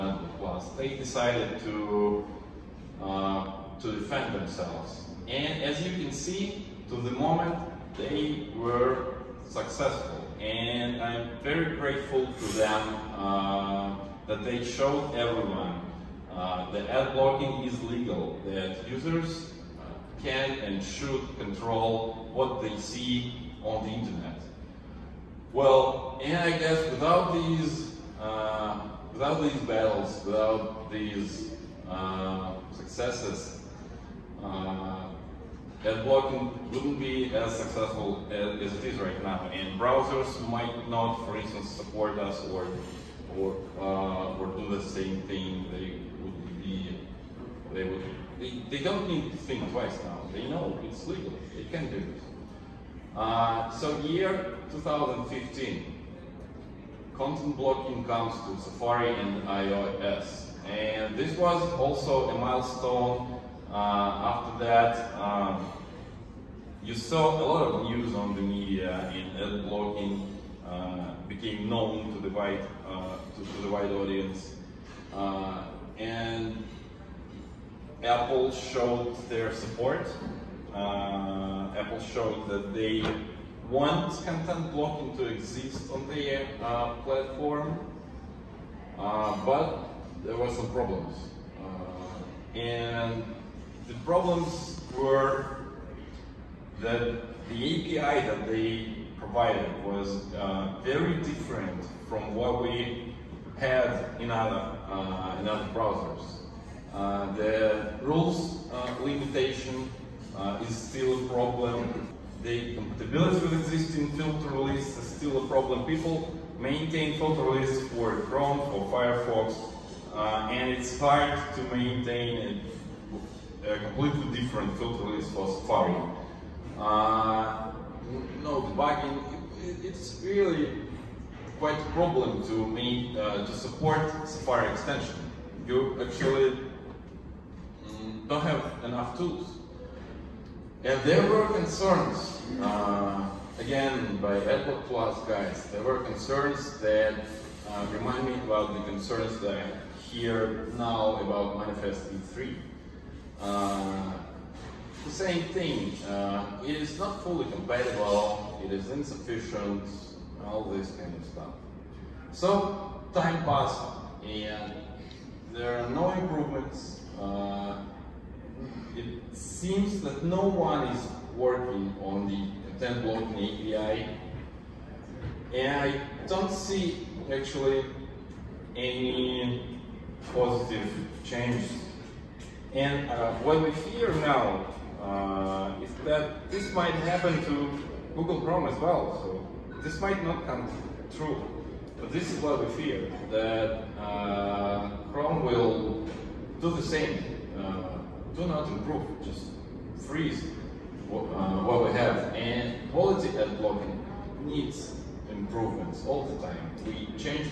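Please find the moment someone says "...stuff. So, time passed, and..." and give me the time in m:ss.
2:41.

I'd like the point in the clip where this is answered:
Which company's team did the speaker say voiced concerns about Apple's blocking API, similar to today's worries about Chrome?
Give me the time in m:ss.
2:24.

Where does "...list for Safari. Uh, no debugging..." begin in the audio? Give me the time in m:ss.
2:05.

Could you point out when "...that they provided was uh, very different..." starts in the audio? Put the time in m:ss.
1:38.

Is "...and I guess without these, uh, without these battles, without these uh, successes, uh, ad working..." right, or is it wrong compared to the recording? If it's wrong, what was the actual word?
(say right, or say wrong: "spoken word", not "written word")
wrong: "blocking", not "working".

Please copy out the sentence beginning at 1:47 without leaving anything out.
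the rules limitation uh, is still a problem.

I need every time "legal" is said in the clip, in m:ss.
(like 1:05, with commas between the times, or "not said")
0:17, 0:51.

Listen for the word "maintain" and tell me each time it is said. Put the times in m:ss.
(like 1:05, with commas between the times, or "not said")
1:56, 2:01.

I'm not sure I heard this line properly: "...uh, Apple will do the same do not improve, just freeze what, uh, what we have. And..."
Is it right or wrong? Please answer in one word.
wrong.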